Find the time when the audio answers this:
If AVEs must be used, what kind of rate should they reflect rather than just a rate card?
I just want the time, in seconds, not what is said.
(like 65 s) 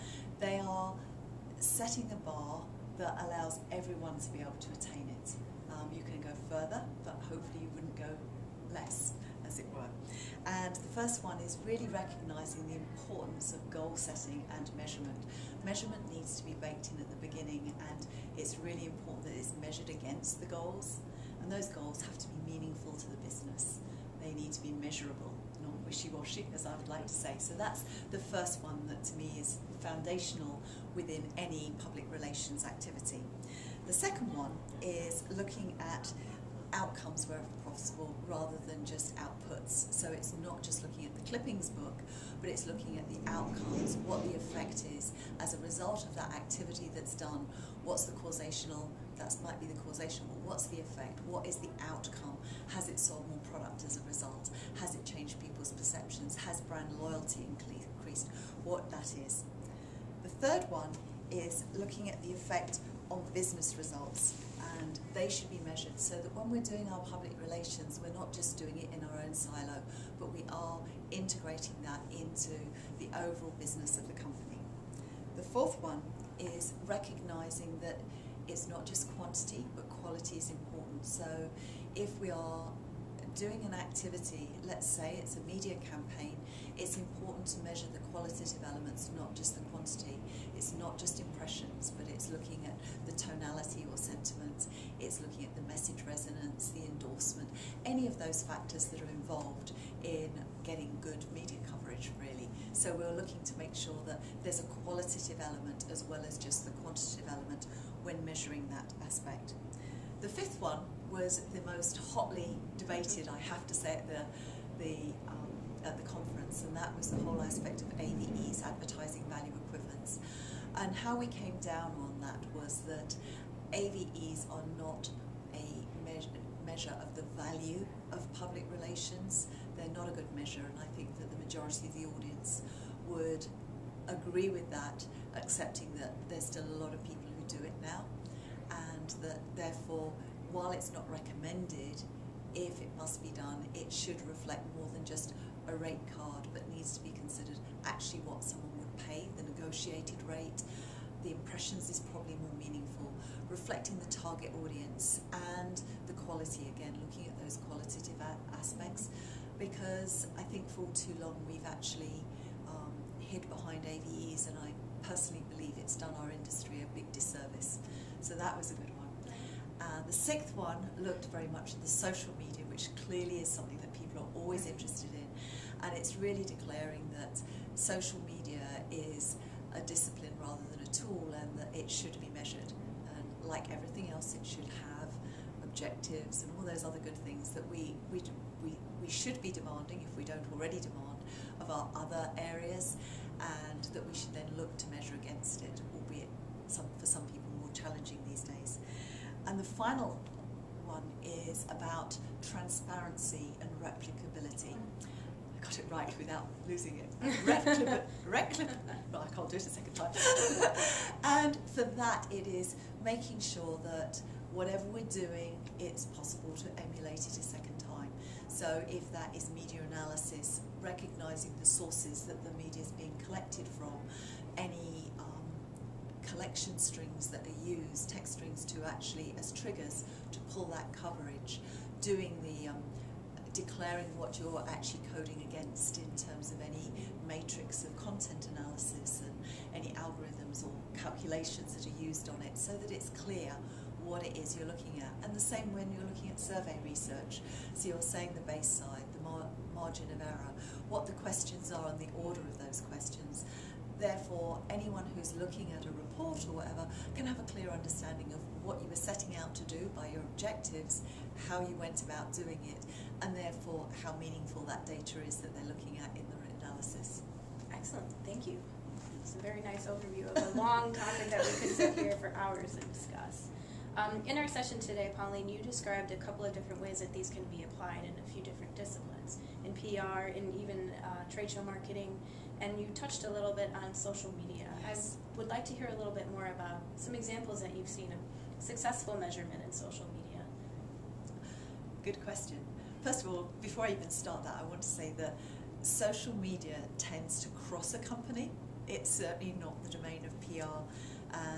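149 s.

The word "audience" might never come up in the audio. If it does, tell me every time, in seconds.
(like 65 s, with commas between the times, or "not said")
132 s, 154 s.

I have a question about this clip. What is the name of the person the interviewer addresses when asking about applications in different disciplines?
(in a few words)
Pauline.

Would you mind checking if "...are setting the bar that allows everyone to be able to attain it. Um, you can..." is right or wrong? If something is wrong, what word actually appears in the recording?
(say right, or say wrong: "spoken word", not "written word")
right.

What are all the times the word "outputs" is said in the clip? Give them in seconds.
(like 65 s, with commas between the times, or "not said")
39 s.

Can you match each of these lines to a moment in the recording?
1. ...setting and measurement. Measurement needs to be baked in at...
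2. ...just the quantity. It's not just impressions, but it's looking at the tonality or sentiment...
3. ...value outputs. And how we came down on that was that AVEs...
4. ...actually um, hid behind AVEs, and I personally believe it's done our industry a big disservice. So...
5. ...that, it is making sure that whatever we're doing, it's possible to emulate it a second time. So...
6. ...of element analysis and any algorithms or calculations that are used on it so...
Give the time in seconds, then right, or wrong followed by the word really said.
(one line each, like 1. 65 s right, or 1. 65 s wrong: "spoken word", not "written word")
1. 13 s right
2. 89 s right
3. 119 s wrong: "equivalents", not "outputs"
4. 161 s right
5. 211 s right
6. 237 s wrong: "content", not "element".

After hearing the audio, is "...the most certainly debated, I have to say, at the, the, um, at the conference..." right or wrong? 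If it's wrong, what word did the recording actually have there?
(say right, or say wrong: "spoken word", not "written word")
wrong: "hotly", not "certainly".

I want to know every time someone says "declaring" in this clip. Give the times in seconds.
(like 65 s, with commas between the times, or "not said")
176 s, 233 s.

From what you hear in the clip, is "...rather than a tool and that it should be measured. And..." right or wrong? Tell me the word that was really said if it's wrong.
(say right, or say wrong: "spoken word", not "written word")
right.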